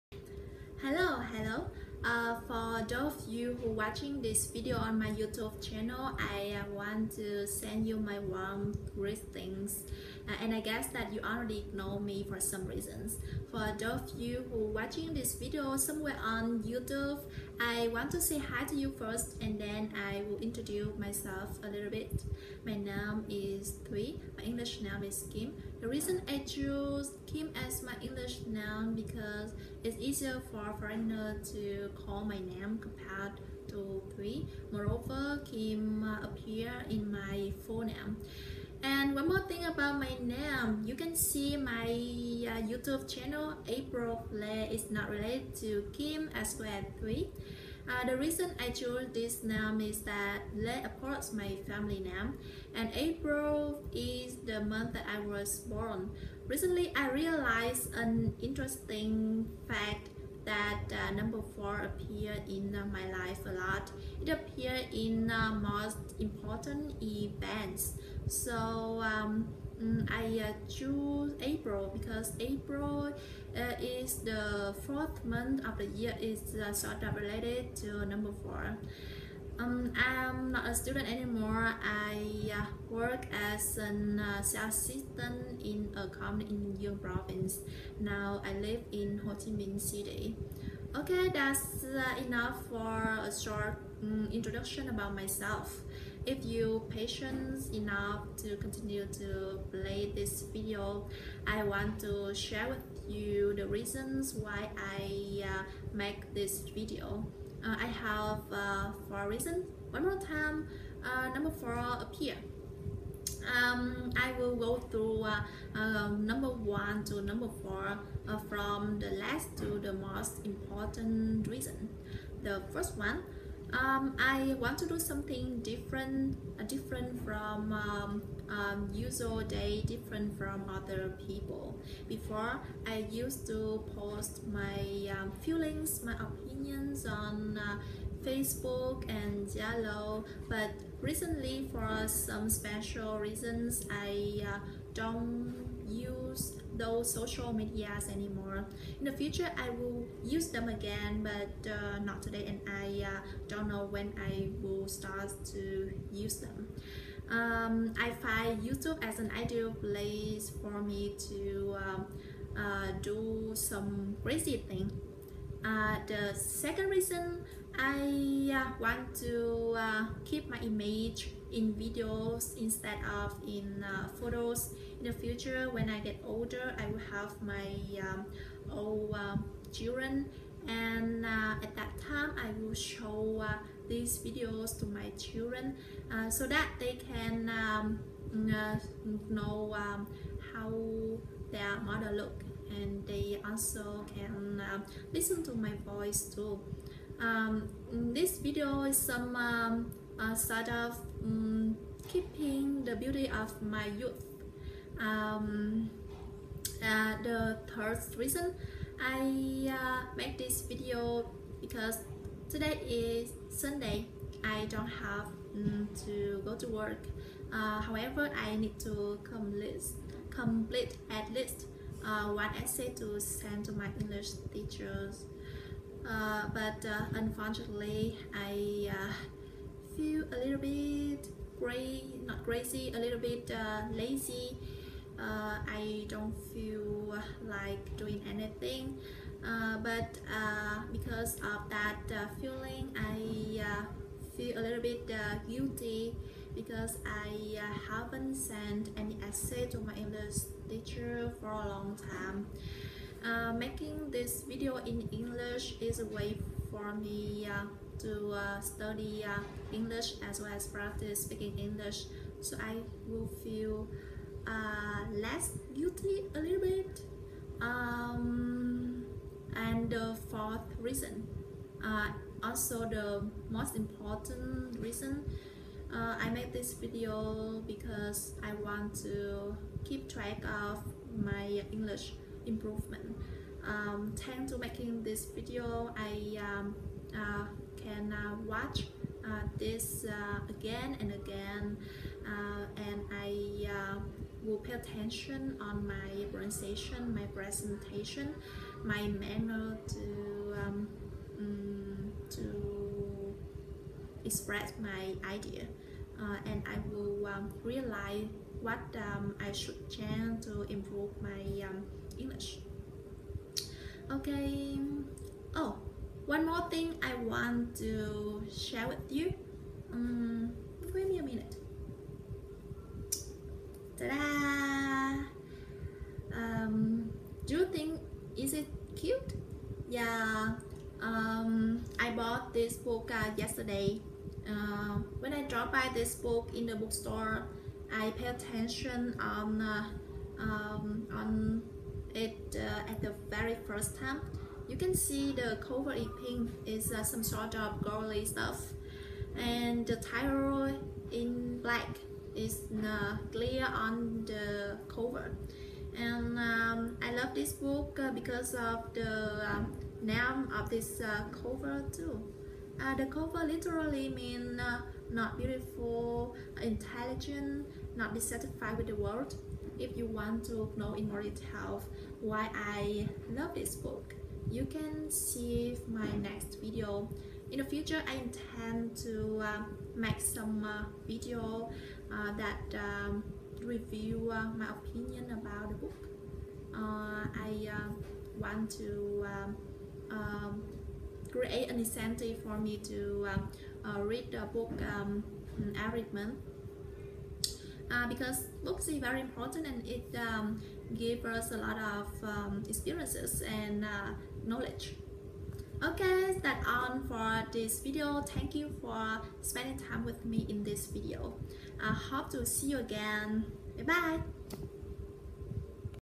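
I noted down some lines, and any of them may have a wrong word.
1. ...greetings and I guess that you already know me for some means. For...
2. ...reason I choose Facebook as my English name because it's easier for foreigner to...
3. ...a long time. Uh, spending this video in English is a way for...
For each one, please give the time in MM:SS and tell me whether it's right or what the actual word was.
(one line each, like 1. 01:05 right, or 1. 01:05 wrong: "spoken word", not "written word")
1. 00:08 wrong: "reasons", not "means"
2. 00:25 wrong: "Kim", not "Facebook"
3. 04:11 wrong: "making", not "spending".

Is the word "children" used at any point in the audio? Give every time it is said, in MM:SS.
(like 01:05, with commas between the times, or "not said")
02:59, 03:05.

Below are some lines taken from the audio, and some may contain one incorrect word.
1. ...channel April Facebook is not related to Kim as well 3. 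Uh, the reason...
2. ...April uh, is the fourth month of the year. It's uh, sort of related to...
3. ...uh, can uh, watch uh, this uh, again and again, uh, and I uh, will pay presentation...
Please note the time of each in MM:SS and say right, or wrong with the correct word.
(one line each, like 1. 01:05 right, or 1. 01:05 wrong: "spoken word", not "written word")
1. 00:43 wrong: "Flair", not "Facebook"
2. 01:12 right
3. 04:47 wrong: "attention", not "presentation".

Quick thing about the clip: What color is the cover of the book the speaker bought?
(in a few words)
Pink.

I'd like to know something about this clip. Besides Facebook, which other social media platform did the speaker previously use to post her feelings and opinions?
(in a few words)
Zalo.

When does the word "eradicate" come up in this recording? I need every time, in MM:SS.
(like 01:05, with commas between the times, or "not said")
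not said.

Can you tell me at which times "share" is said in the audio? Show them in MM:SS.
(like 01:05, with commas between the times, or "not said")
01:42, 05:18.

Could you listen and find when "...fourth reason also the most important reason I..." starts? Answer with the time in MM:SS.
04:30.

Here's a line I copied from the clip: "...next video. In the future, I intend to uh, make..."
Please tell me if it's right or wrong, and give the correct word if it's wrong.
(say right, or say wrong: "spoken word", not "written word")
right.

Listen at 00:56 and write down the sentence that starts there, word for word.
Recently, I realized an interesting fact that uh, number four appear in uh, my life a lot.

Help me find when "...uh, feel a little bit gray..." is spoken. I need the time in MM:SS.
03:48.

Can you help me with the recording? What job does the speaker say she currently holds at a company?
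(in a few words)
Sales assistant.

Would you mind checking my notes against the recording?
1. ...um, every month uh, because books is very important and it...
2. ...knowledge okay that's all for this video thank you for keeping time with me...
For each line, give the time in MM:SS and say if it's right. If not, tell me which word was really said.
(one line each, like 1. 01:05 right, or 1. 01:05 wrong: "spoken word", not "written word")
1. 06:34 right
2. 06:44 wrong: "spending", not "keeping".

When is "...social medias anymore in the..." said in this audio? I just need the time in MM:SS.
02:27.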